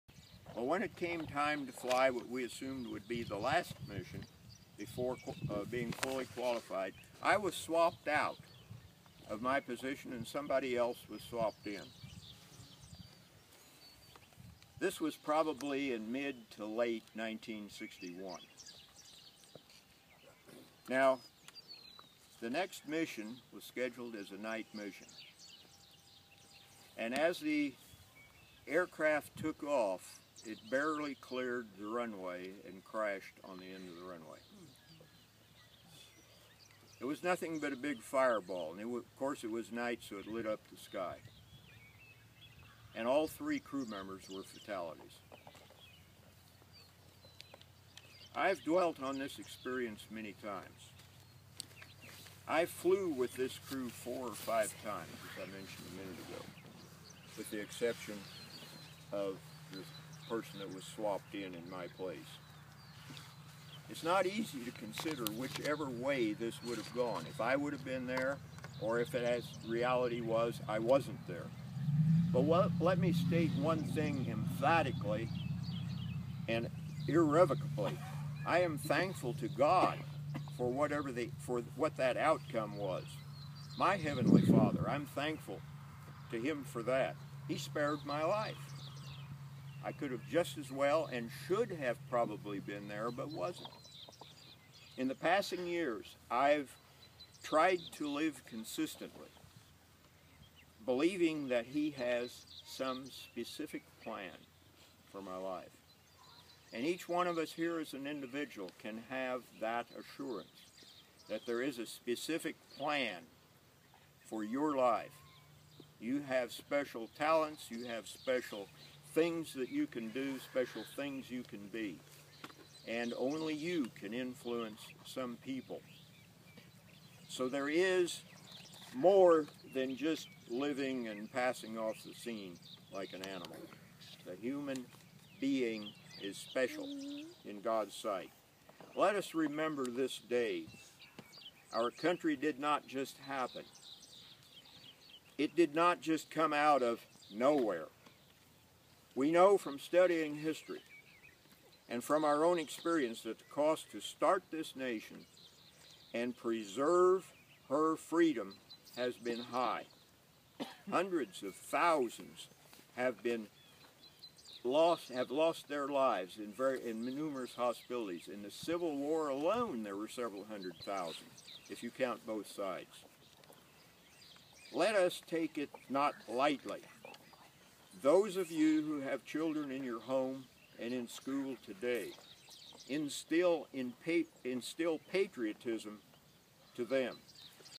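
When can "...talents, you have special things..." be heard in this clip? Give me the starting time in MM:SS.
01:57.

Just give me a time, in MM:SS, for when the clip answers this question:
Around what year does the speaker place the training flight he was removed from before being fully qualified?
00:17.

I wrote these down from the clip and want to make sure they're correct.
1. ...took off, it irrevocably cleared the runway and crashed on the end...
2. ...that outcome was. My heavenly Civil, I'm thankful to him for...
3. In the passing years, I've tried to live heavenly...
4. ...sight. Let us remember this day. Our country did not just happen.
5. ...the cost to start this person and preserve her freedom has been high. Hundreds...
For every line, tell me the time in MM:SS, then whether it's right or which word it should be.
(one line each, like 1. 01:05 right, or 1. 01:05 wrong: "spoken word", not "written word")
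1. 00:29 wrong: "barely", not "irrevocably"
2. 01:21 wrong: "Father", not "Civil"
3. 01:34 wrong: "consistently", not "heavenly"
4. 02:17 right
5. 02:33 wrong: "nation", not "person".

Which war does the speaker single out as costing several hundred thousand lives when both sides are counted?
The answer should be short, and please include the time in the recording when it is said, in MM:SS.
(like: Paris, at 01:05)
Civil War, at 02:48.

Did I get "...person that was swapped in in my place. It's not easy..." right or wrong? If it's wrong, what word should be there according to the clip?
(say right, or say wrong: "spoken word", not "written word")
right.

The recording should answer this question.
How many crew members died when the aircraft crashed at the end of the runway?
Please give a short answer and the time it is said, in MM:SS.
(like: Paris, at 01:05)
3, at 00:43.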